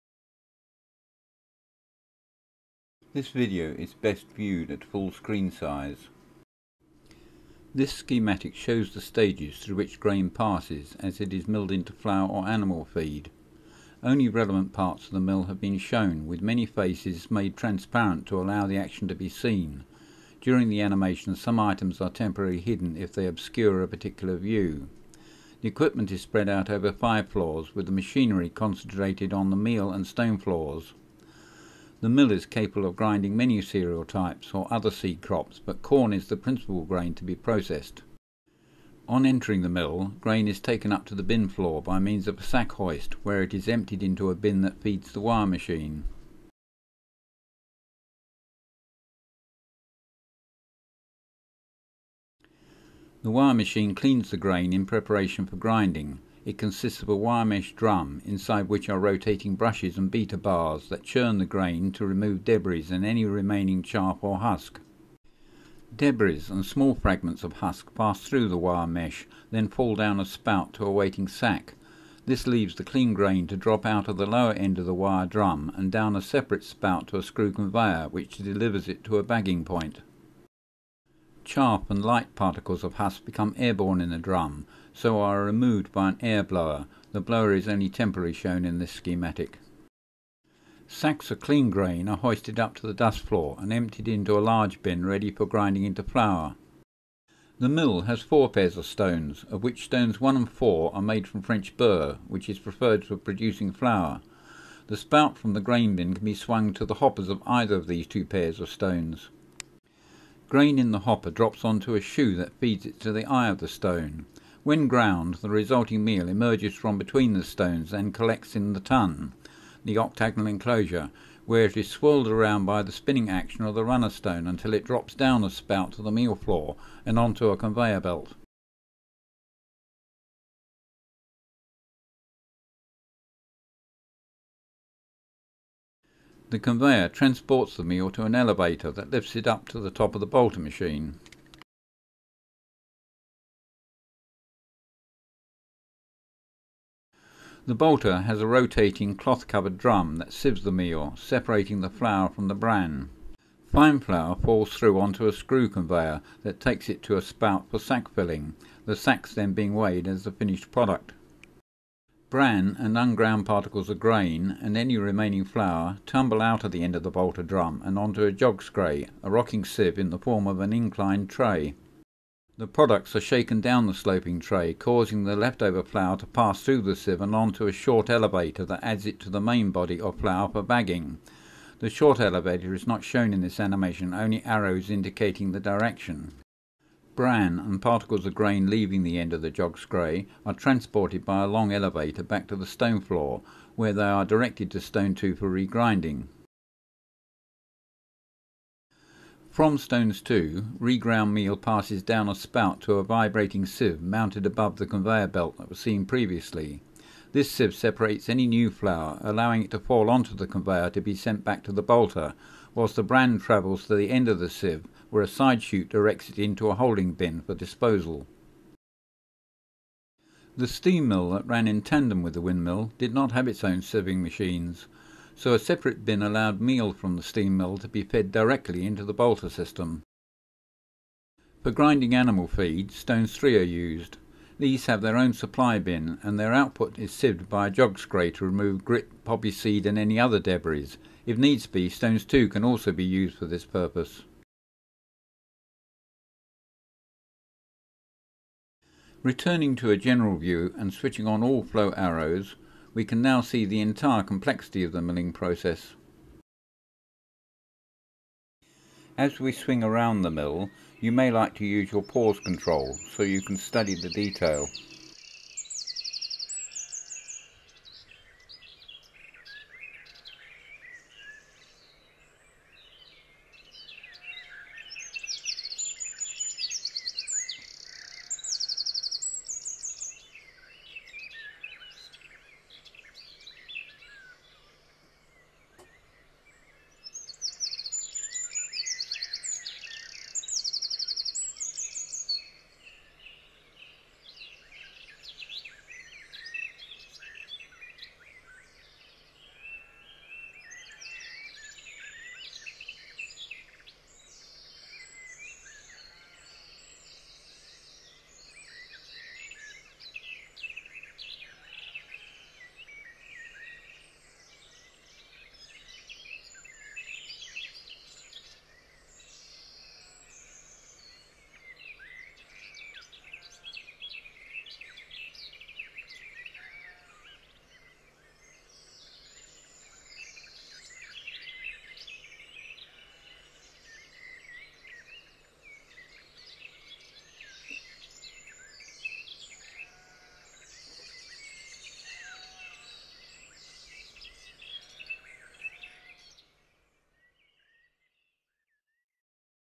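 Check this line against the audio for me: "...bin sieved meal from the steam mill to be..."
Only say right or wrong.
wrong.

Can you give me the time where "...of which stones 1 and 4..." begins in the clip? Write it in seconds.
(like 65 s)
99 s.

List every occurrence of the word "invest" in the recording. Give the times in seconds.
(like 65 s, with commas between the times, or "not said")
not said.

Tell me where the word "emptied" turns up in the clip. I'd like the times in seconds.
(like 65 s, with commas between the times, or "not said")
43 s, 93 s.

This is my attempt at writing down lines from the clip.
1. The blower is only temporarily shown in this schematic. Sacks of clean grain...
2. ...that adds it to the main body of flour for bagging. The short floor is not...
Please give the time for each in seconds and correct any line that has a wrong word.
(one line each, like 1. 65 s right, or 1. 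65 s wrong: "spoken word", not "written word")
1. 87 s right
2. 178 s wrong: "elevator", not "floor".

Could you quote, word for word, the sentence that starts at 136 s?
The conveyor transports the meal to an elevator that lifts it up to the top of the bolter machine.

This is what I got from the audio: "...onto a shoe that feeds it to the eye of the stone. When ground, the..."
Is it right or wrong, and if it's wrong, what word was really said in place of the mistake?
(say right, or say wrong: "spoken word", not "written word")
right.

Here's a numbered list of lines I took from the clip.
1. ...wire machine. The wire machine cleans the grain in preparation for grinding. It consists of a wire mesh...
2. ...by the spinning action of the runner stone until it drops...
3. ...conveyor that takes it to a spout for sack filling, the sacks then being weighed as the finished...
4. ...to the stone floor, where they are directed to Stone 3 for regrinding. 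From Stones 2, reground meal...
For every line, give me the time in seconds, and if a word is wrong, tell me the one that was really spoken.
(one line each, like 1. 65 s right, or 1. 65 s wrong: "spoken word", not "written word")
1. 45 s right
2. 122 s right
3. 155 s right
4. 192 s wrong: "2", not "3".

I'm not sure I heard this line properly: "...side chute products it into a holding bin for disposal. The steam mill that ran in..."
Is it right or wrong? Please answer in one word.
wrong.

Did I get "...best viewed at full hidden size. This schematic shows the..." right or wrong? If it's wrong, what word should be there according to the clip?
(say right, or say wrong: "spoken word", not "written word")
wrong: "screen", not "hidden".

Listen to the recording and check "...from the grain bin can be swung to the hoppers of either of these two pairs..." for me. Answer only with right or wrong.
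right.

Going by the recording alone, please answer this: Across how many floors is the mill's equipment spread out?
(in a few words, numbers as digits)
5.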